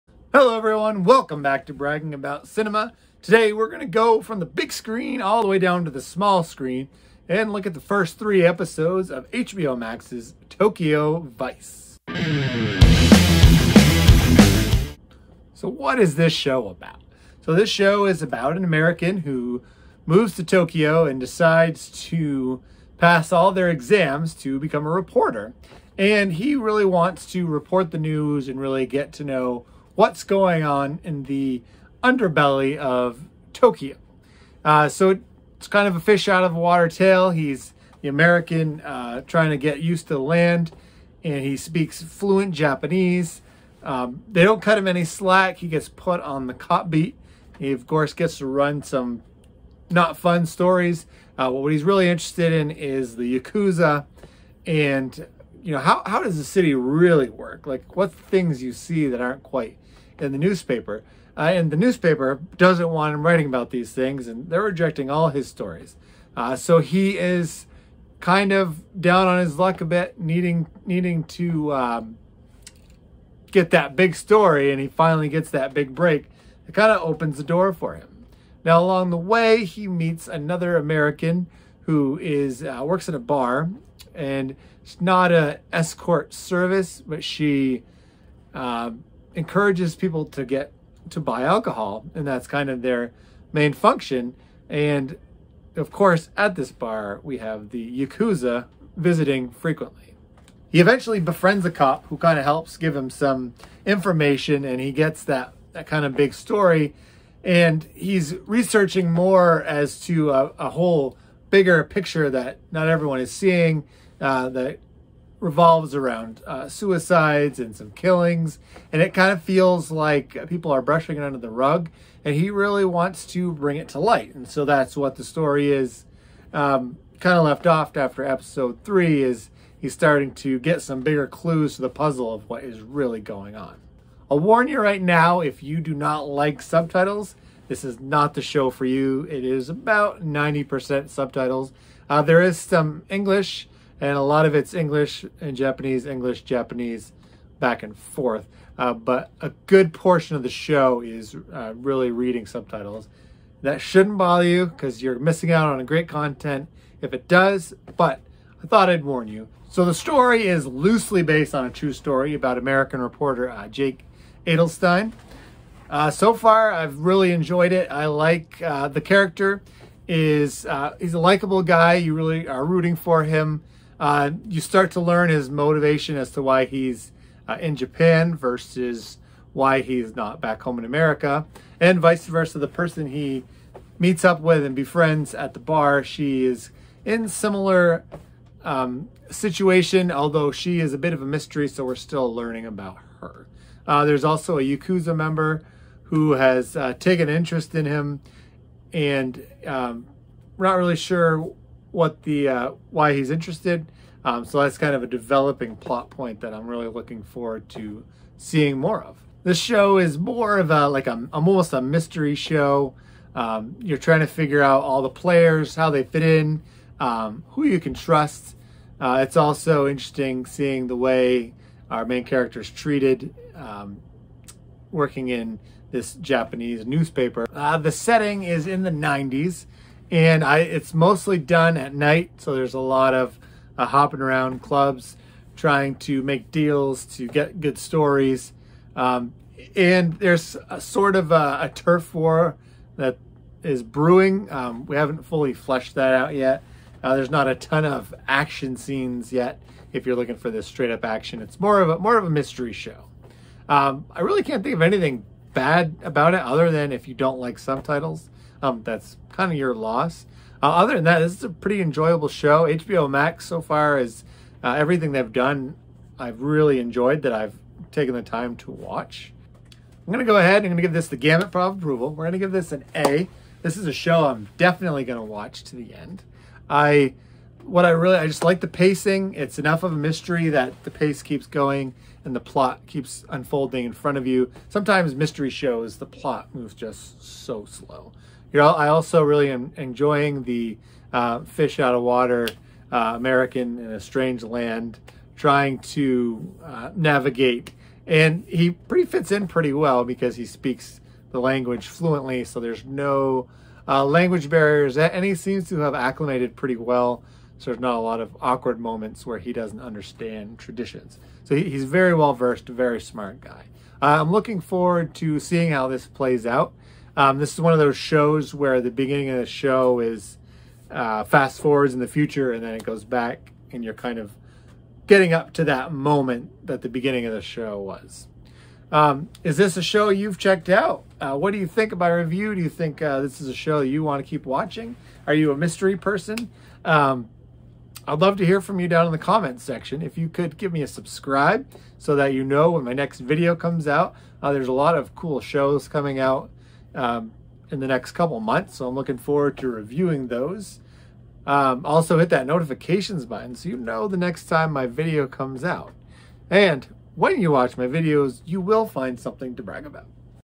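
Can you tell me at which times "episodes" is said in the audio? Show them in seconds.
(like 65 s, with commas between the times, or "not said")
8 s, 128 s.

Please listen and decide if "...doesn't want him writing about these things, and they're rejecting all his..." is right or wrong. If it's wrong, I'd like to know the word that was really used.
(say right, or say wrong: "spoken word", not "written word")
right.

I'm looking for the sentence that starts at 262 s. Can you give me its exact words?
HBO Max so far is uh, everything they've done.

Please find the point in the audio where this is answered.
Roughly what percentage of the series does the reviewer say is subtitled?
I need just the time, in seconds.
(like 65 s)
140 s.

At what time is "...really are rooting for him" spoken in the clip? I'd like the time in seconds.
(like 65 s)
172 s.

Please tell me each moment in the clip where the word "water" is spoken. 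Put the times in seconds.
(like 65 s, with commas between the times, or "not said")
36 s, 292 s.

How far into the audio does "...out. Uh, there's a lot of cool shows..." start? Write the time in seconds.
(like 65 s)
343 s.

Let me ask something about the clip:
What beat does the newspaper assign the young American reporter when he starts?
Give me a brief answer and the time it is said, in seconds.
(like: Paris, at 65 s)
the cop beat, at 46 s.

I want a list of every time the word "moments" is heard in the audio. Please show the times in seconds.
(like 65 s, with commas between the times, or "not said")
308 s, 325 s.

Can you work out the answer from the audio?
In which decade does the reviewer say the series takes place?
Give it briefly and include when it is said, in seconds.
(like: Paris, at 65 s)
the 90s, at 228 s.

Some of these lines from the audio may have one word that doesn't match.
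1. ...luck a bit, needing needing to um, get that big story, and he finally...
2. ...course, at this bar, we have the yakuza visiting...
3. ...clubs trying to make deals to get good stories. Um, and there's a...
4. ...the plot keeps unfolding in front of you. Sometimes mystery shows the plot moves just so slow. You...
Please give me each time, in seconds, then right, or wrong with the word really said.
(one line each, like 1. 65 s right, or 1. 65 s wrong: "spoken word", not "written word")
1. 69 s right
2. 95 s right
3. 234 s right
4. 282 s right.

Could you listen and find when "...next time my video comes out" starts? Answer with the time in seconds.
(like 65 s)
354 s.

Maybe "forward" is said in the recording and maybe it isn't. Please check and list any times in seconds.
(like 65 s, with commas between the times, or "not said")
207 s, 314 s, 321 s, 349 s.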